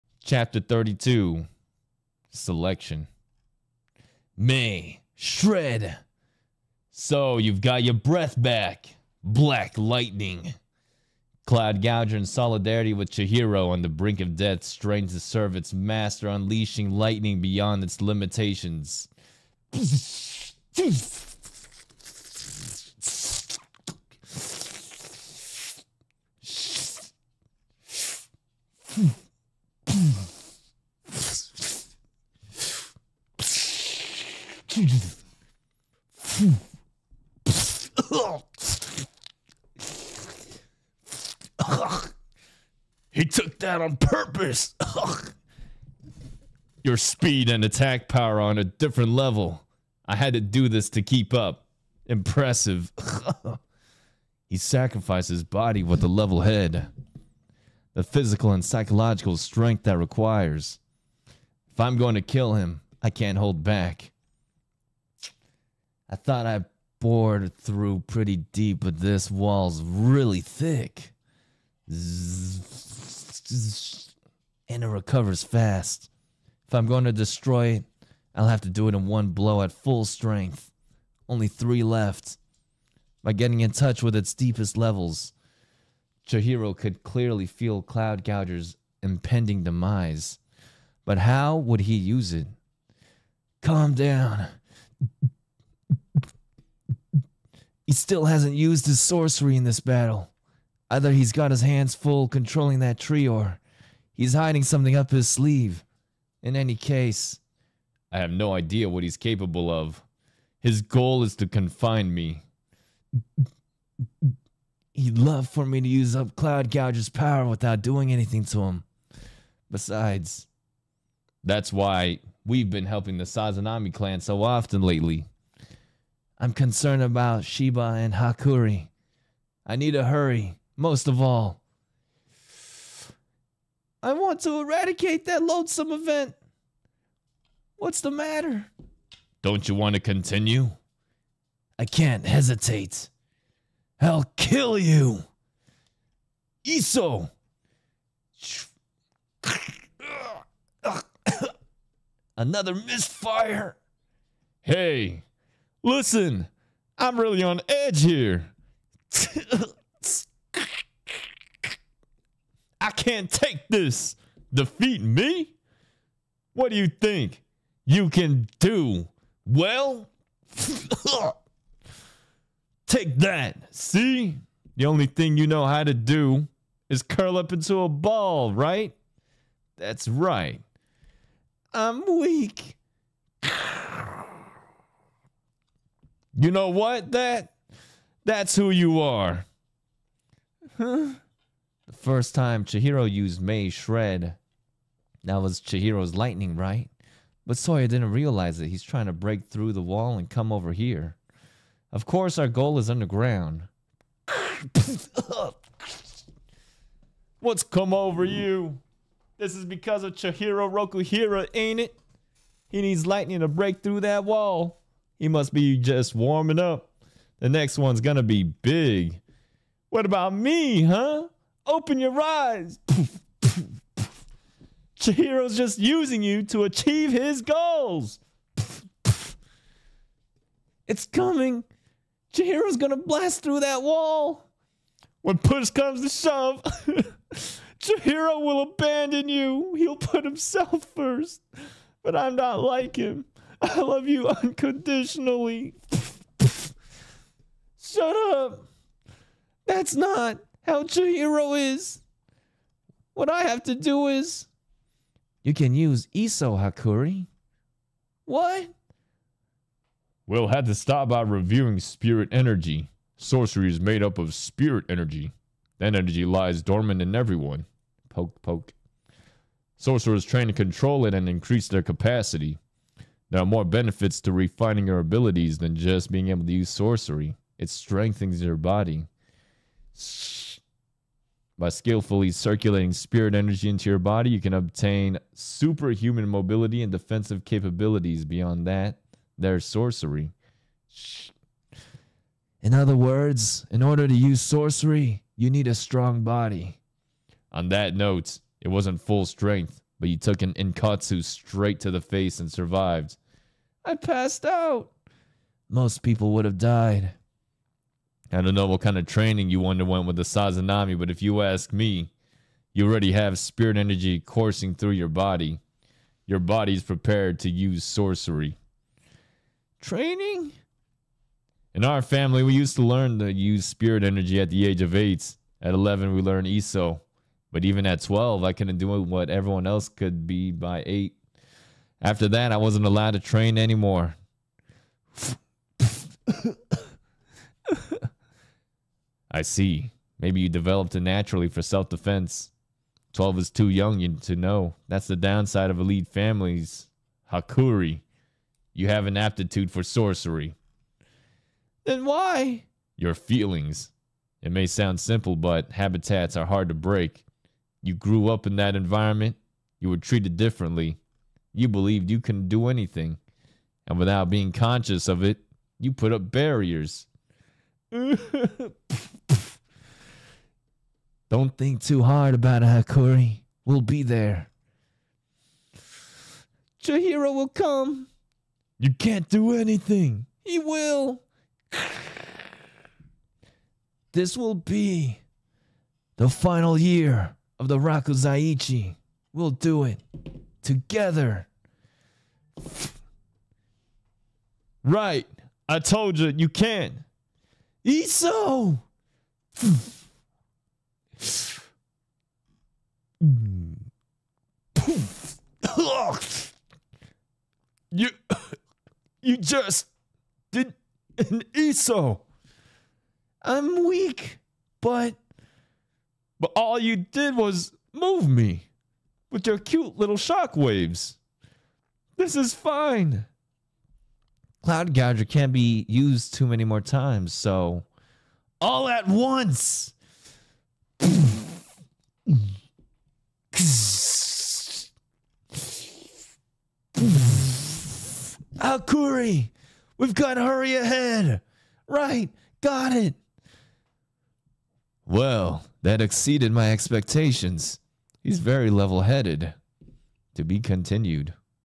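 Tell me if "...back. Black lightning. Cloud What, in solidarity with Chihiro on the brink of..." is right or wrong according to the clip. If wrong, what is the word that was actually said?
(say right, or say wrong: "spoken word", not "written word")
wrong: "Gouger", not "What".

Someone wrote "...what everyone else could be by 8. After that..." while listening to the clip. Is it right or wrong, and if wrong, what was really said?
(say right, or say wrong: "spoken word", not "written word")
right.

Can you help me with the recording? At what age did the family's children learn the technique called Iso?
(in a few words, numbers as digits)
11.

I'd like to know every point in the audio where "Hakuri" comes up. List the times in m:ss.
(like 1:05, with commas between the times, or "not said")
2:08, 4:16, 5:47, 6:12, 7:18.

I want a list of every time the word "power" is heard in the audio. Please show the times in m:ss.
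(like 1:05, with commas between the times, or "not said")
0:48, 1:57.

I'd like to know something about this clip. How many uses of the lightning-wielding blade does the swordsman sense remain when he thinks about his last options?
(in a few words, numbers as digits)
3.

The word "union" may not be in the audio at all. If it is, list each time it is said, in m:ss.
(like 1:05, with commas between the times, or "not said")
not said.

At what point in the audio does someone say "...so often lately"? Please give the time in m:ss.
2:04.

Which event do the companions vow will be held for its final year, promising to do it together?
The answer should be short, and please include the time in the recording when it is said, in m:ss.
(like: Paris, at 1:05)
Rakuzaichi, at 6:27.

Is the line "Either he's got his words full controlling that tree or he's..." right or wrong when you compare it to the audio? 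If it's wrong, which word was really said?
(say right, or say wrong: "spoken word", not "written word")
wrong: "hands", not "words".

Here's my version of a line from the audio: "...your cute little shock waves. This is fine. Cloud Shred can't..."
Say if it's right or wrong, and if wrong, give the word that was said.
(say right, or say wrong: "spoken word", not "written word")
wrong: "Gouger", not "Shred".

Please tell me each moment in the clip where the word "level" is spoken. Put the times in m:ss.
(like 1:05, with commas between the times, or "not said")
0:49, 0:56, 1:24, 7:28.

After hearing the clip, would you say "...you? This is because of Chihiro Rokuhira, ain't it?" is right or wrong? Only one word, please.
right.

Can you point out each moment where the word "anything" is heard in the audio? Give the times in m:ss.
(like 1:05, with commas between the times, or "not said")
1:58, 6:02, 6:19.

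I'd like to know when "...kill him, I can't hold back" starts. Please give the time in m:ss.
1:02.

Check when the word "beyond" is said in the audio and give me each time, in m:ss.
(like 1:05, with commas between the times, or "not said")
0:17, 4:48.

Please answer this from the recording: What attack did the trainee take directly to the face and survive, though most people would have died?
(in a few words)
Inkatsu.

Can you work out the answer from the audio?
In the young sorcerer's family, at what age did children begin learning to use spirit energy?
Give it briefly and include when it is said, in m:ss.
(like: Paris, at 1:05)
8, at 5:24.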